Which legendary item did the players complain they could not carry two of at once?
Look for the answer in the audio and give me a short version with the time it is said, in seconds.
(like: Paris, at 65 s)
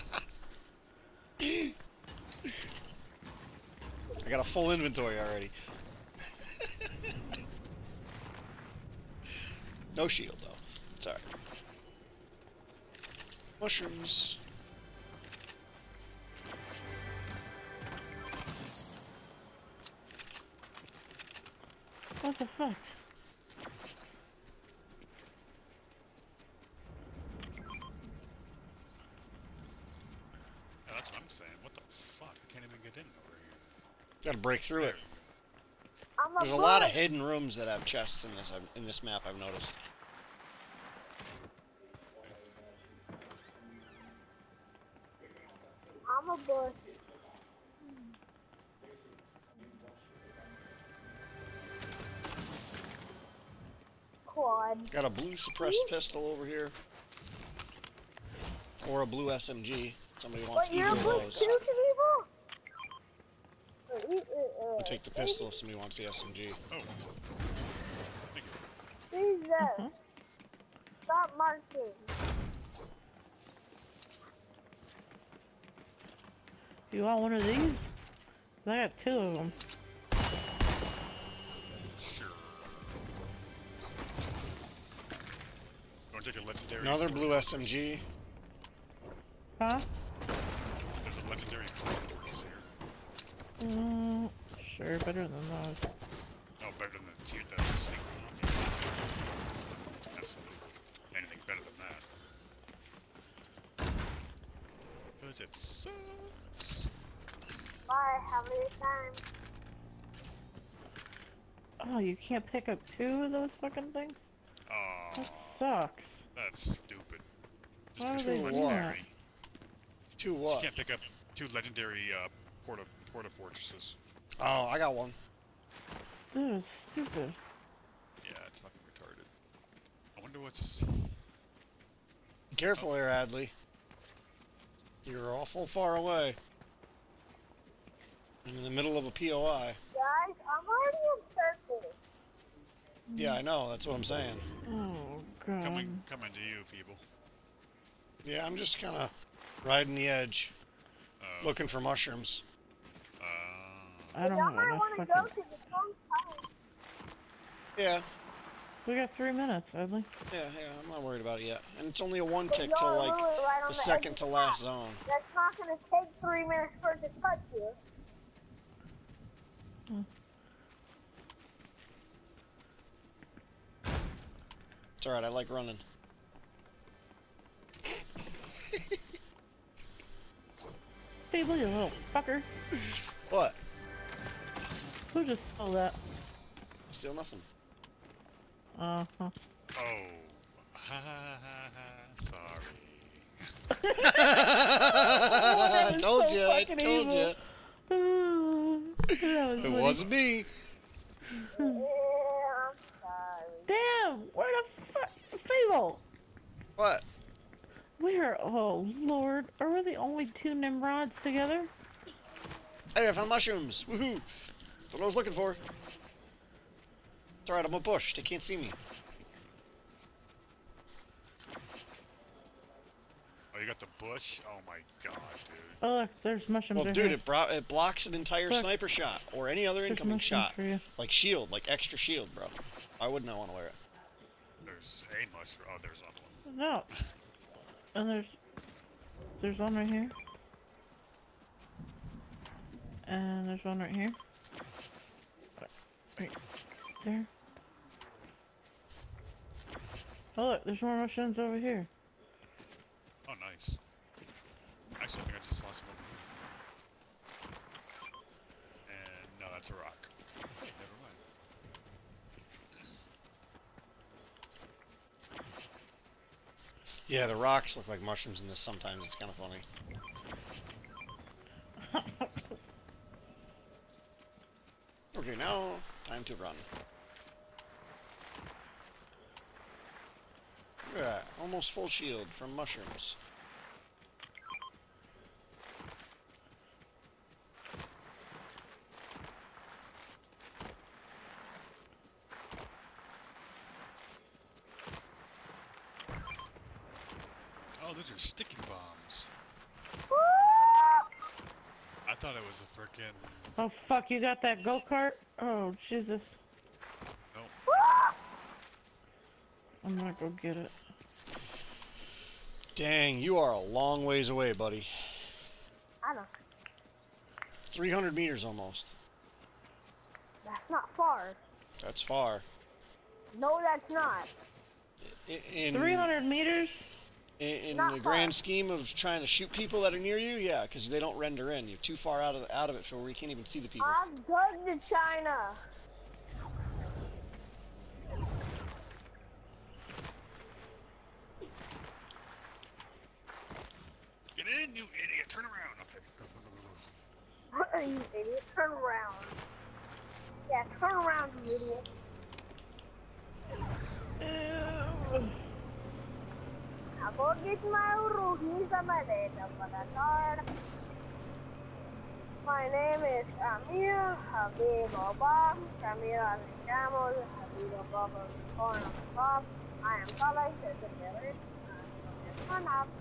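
porta fortresses, at 123 s.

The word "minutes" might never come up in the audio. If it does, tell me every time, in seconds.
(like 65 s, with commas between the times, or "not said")
159 s, 166 s.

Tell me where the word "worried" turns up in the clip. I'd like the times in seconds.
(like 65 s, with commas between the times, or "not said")
161 s.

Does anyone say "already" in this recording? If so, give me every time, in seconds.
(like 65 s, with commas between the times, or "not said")
5 s, 140 s.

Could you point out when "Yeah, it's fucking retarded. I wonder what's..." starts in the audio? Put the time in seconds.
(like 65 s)
128 s.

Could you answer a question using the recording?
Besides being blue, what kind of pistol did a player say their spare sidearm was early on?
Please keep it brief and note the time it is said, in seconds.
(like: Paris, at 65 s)
suppressed, at 55 s.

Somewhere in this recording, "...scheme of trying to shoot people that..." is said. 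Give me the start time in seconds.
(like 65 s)
328 s.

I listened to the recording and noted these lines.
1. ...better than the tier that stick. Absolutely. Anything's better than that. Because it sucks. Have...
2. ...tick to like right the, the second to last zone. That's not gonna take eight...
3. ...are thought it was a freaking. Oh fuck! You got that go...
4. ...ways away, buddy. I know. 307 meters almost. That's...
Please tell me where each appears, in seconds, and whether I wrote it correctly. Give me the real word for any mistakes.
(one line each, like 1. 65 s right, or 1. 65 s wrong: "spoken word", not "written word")
1. 96 s right
2. 162 s wrong: "three", not "eight"
3. 298 s right
4. 314 s wrong: "300", not "307".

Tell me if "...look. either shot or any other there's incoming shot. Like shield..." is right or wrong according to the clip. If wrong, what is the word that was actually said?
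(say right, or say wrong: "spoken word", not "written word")
wrong: "sniper", not "either".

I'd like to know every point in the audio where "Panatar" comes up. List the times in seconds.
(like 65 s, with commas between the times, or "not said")
359 s.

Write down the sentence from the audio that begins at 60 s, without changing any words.
Somebody wants but either of those.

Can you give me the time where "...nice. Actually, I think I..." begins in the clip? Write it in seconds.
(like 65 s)
253 s.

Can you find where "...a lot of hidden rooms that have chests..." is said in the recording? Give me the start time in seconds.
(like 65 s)
36 s.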